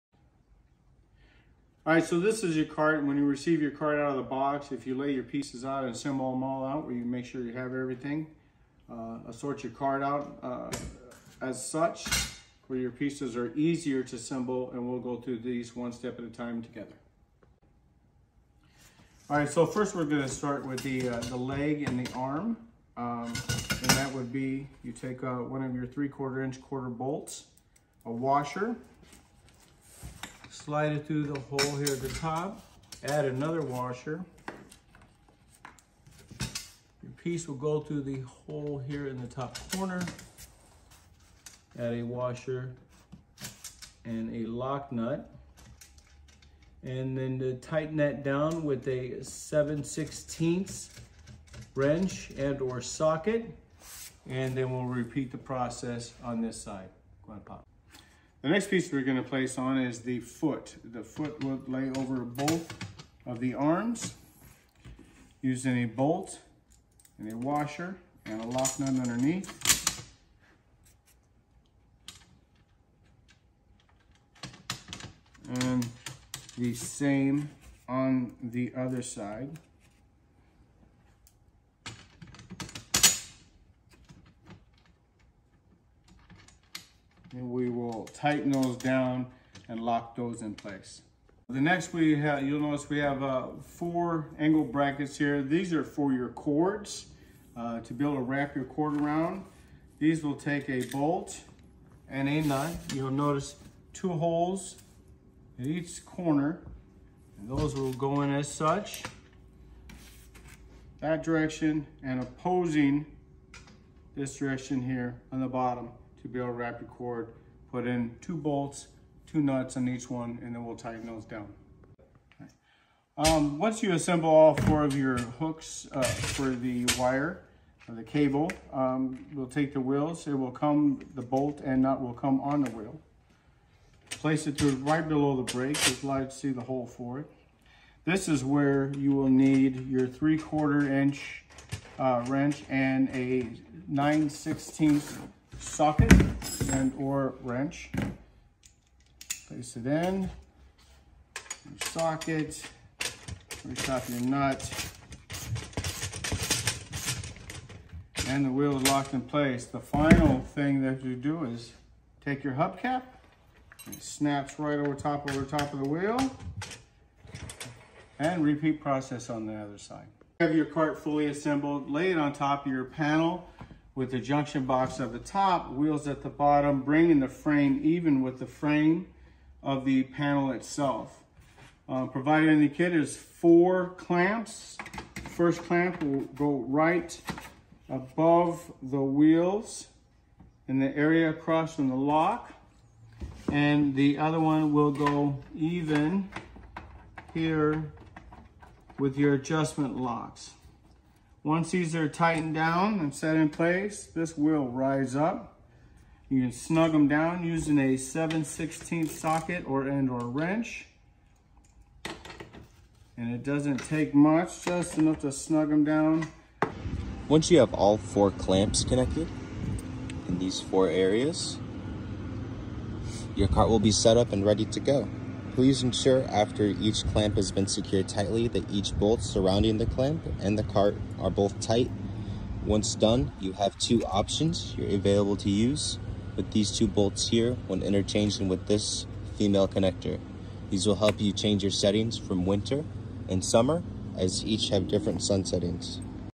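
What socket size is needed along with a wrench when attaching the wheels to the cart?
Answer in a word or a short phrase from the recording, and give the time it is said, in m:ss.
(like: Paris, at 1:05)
9/16, at 2:23.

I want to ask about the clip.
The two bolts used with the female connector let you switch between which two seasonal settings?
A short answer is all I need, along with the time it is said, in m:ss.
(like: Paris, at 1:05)
Winter and summer, at 4:02.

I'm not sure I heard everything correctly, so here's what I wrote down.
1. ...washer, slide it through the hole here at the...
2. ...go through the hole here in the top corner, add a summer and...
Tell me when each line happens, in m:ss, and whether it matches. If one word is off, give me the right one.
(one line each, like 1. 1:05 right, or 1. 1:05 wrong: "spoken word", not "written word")
1. 0:28 right
2. 0:37 wrong: "washer", not "summer".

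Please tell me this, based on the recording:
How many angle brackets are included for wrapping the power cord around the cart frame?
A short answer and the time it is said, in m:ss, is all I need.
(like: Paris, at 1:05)
4, at 1:33.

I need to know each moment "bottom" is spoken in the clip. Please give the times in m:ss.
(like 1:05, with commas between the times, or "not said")
1:55, 2:56.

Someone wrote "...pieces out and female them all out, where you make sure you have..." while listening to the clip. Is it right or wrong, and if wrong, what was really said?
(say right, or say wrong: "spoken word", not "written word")
wrong: "assemble", not "female".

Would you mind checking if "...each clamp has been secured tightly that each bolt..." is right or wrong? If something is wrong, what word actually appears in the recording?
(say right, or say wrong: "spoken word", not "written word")
right.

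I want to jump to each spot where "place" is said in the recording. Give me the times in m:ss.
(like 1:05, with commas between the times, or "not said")
0:59, 1:30, 2:14, 2:29, 2:39, 3:23.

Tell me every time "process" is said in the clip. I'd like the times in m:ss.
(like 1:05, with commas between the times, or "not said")
0:55, 2:48.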